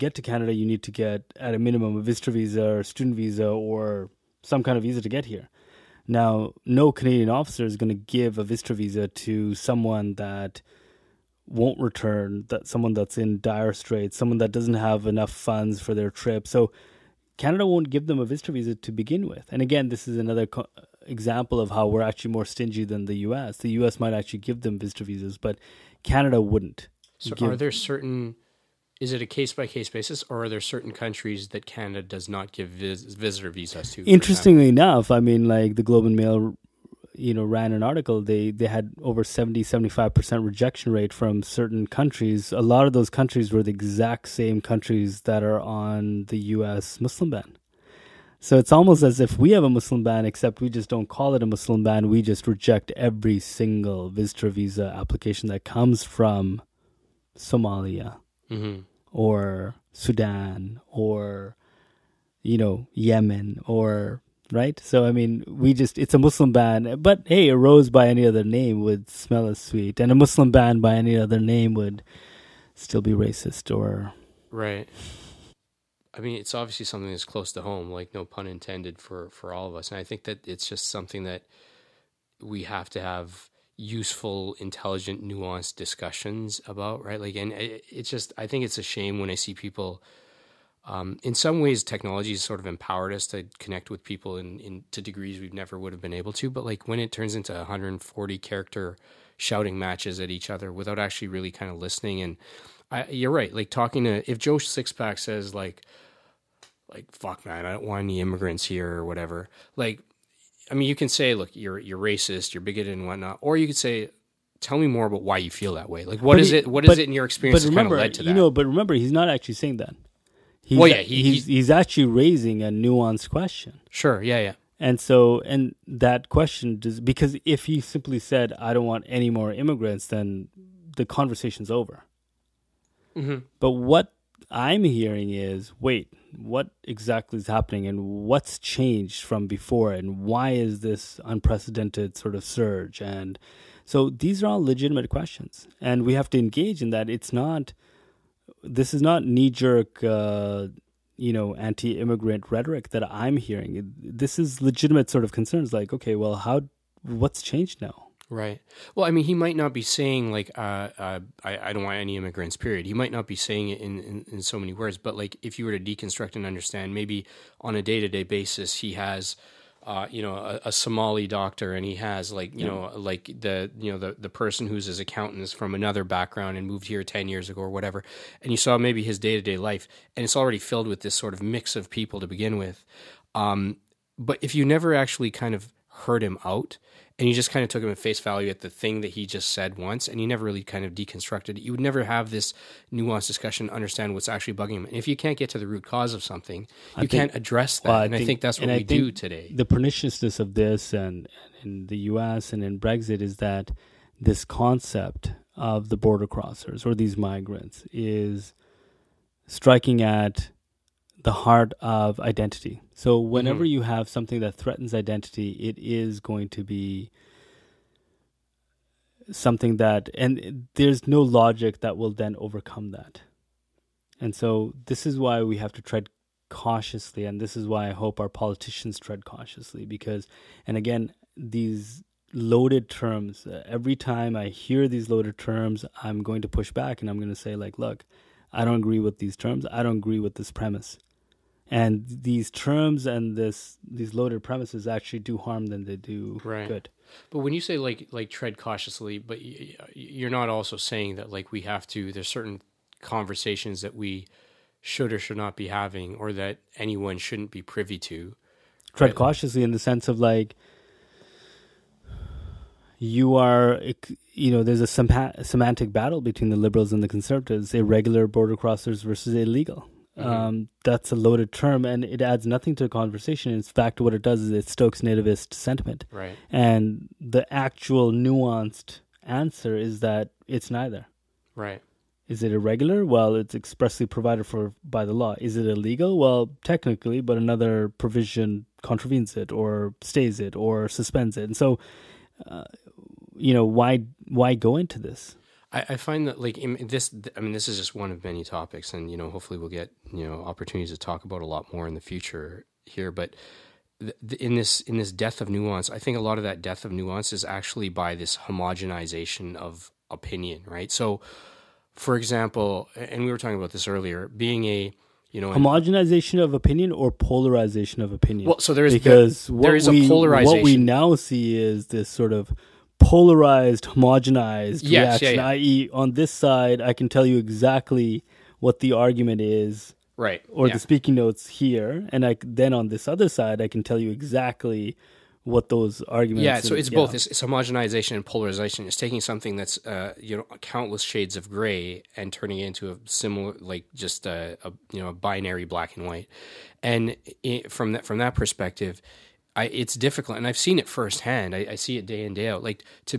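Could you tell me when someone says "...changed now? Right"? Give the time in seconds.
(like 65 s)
157 s.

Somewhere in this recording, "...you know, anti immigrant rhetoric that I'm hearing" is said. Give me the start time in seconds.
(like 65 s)
151 s.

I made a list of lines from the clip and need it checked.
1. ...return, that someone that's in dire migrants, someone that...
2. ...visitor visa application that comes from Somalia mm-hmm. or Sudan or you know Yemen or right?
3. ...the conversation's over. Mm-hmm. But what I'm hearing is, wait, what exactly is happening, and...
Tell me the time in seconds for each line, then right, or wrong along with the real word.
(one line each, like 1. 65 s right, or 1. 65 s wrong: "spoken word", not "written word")
1. 11 s wrong: "straits", not "migrants"
2. 54 s right
3. 130 s right.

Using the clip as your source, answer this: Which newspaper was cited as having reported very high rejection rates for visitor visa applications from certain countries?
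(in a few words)
The Globe and Mail.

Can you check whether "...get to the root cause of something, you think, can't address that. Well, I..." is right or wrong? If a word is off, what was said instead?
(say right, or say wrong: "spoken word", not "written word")
right.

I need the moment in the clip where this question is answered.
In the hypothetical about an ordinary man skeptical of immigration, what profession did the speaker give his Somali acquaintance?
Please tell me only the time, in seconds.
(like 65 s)
171 s.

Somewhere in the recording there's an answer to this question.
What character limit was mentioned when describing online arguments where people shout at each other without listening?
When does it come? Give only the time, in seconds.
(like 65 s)
97 s.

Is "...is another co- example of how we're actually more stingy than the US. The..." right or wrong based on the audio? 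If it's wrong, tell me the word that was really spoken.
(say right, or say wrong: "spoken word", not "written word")
right.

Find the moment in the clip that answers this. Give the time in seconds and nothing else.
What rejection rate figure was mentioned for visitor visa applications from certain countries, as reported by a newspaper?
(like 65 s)
39 s.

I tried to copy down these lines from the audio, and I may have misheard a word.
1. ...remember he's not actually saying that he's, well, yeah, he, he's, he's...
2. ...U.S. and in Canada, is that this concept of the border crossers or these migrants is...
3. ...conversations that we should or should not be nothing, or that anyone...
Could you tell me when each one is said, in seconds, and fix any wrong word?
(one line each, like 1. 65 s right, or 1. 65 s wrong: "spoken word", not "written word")
1. 118 s right
2. 201 s wrong: "Brexit", not "Canada"
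3. 253 s wrong: "having", not "nothing".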